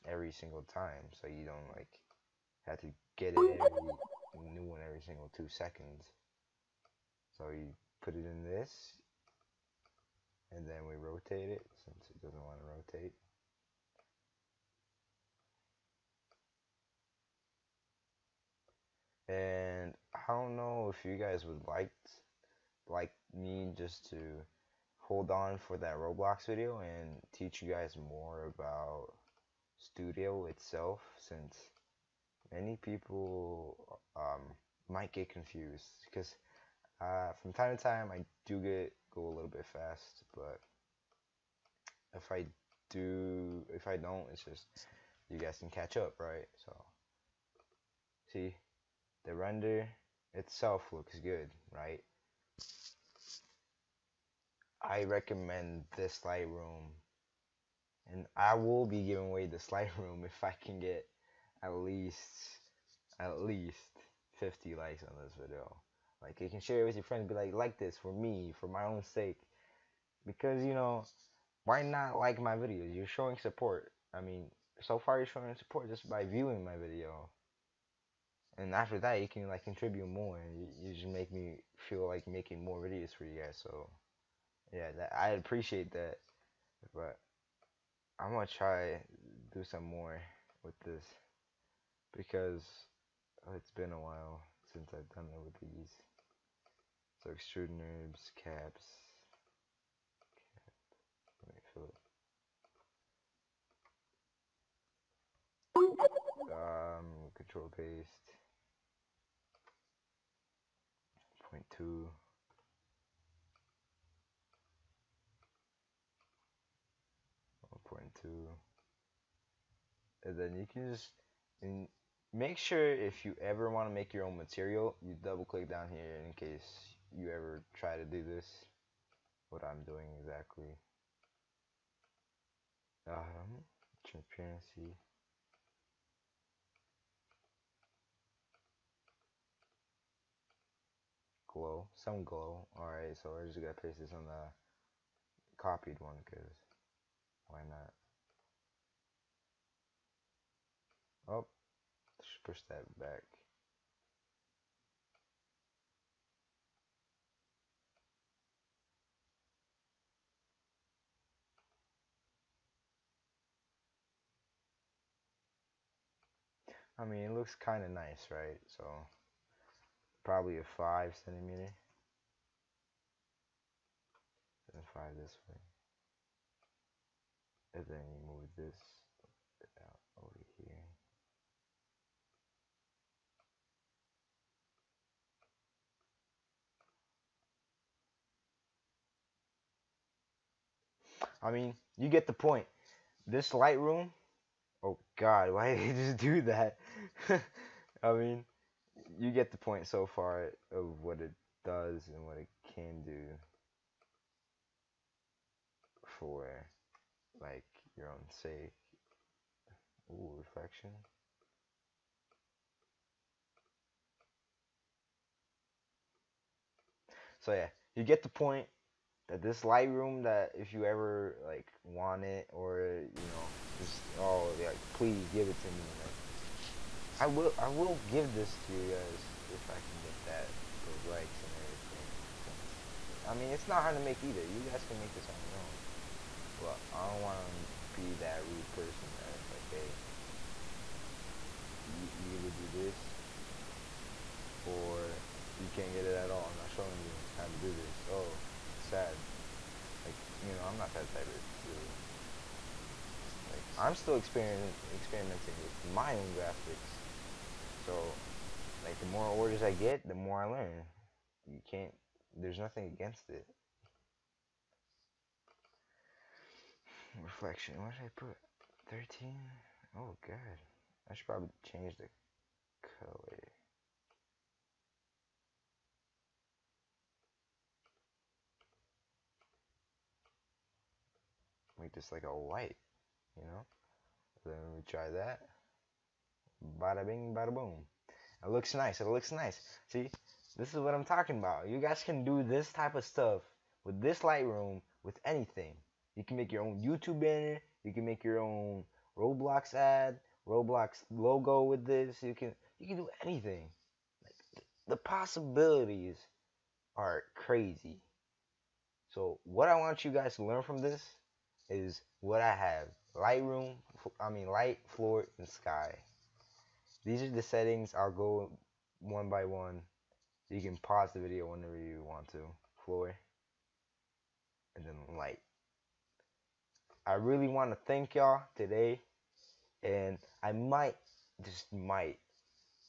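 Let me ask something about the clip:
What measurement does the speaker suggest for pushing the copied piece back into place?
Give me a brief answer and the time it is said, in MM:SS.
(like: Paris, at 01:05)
5 centimeters, at 02:50.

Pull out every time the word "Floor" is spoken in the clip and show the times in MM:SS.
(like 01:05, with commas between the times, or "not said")
05:14, 05:22.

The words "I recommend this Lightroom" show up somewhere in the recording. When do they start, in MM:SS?
00:54.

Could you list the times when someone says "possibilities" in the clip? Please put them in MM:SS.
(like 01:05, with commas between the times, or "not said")
05:04.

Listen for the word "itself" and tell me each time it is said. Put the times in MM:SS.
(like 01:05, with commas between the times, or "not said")
00:30, 00:50.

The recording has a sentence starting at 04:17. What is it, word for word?
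So, like the more orders I get, the more I learn.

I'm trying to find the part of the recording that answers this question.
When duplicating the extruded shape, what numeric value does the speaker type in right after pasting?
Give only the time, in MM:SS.
01:57.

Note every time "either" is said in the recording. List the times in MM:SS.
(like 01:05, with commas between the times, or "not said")
03:54, 04:02.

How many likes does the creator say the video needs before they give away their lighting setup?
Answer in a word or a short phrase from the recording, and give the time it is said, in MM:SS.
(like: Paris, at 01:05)
50, at 01:04.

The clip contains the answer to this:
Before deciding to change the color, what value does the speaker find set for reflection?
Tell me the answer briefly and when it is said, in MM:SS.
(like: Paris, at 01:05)
13, at 04:28.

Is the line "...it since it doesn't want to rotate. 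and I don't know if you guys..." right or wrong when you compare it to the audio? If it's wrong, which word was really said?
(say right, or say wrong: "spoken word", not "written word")
right.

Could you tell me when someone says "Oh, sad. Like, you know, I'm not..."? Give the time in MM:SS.
04:08.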